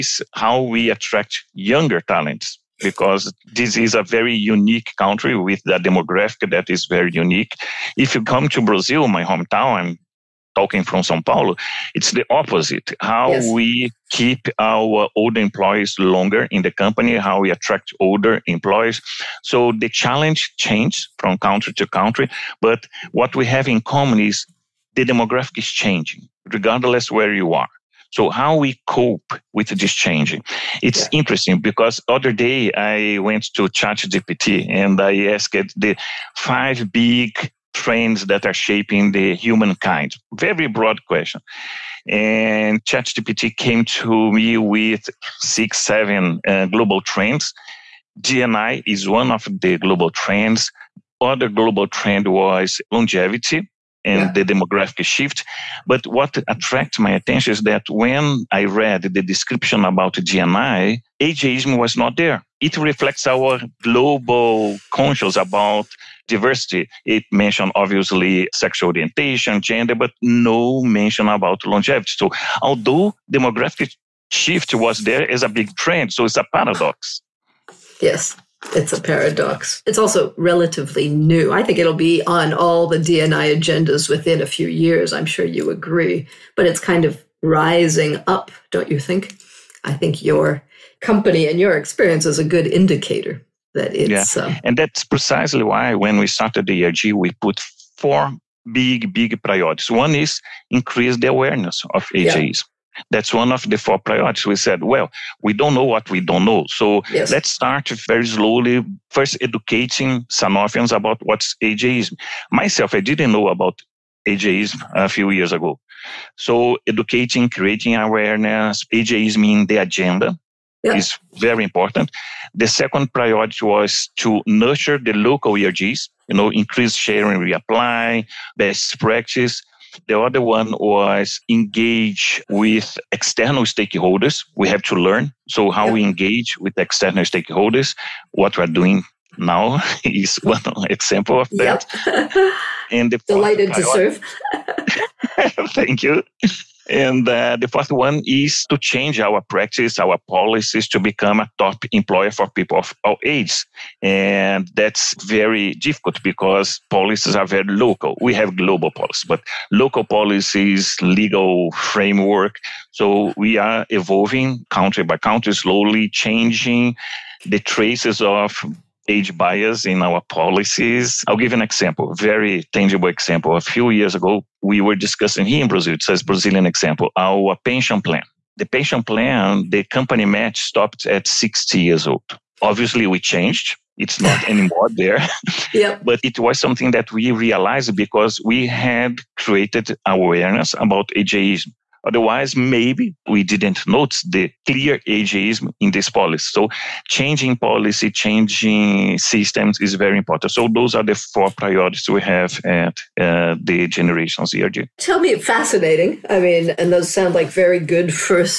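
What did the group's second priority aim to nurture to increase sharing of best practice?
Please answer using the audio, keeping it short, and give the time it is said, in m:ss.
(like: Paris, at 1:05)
local ERGs, at 2:05.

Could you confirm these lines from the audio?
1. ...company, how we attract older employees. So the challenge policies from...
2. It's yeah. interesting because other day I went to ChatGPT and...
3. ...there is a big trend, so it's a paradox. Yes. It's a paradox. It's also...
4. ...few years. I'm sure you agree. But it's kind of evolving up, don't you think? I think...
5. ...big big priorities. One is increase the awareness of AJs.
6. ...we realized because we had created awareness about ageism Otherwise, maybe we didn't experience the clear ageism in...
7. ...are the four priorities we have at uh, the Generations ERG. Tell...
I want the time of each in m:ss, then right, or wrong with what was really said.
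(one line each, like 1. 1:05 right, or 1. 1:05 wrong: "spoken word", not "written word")
1. 0:16 wrong: "changes", not "policies"
2. 0:30 right
3. 1:14 right
4. 1:24 wrong: "rising", not "evolving"
5. 1:38 right
6. 3:07 wrong: "notice", not "experience"
7. 3:20 right.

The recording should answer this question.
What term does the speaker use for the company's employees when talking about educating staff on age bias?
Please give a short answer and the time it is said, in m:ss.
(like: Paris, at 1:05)
Sanofians, at 1:50.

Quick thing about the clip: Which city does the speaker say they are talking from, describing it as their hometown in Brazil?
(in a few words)
Sao Paulo.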